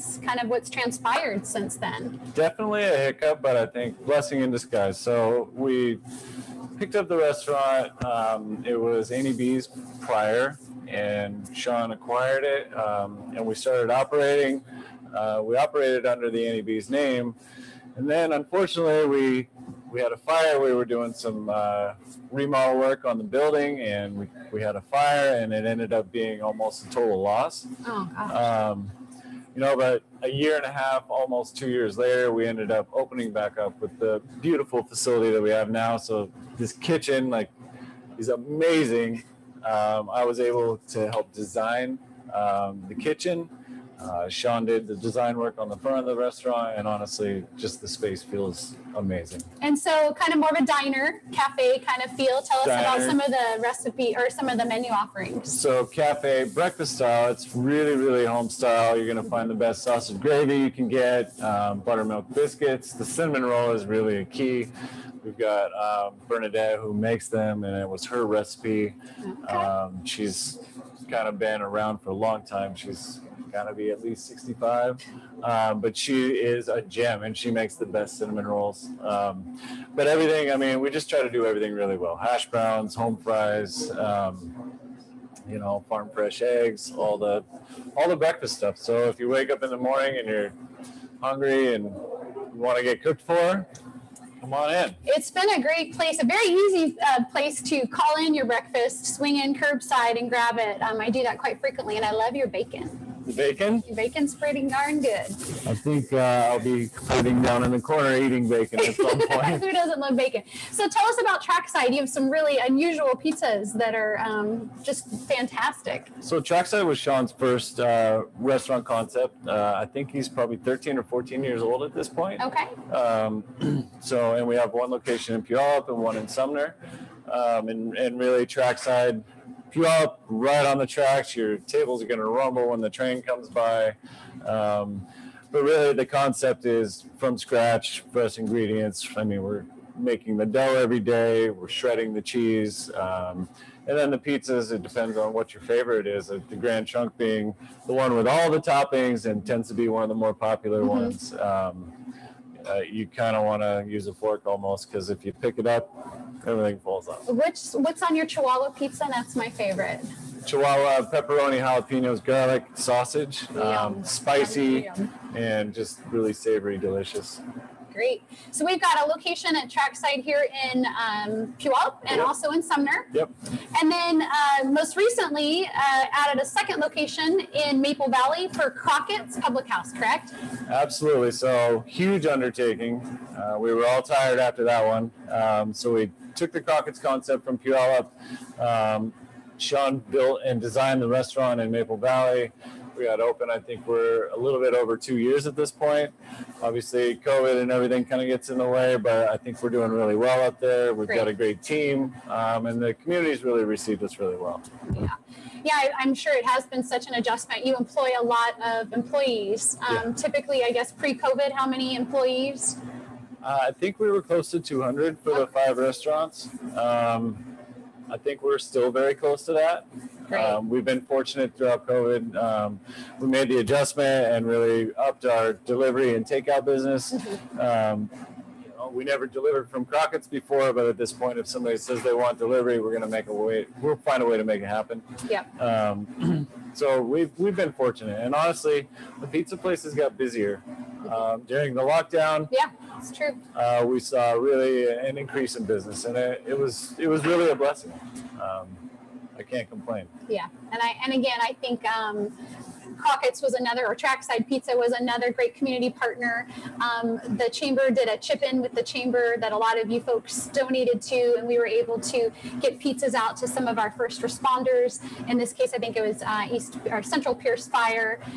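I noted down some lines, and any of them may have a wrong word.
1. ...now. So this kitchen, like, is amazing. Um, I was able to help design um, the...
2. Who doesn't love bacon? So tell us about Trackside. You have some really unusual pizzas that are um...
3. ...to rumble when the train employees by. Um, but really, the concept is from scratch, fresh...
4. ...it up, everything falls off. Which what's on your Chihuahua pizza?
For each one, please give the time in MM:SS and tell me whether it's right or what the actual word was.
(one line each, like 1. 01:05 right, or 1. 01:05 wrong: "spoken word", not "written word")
1. 00:35 right
2. 01:49 right
3. 02:12 wrong: "comes", not "employees"
4. 02:35 right.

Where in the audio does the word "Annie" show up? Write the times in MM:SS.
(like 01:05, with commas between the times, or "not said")
00:09, 00:16.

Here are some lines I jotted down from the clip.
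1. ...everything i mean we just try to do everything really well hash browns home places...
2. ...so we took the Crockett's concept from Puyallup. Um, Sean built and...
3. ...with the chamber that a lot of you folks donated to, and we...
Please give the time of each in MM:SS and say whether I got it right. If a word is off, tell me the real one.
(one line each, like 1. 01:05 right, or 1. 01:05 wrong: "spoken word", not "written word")
1. 01:20 wrong: "fries", not "places"
2. 03:05 right
3. 04:18 right.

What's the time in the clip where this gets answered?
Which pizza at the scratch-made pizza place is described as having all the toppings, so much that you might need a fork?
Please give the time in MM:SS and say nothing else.
02:26.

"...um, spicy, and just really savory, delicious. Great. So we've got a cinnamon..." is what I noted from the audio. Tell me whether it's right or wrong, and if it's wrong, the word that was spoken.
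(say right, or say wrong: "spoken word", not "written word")
wrong: "location", not "cinnamon".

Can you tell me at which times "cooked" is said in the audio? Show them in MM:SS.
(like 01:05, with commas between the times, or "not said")
01:33.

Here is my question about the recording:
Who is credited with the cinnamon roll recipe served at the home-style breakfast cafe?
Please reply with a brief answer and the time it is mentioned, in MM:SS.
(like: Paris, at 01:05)
Bernadette, at 01:06.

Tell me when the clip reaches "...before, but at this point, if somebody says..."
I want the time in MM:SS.
03:50.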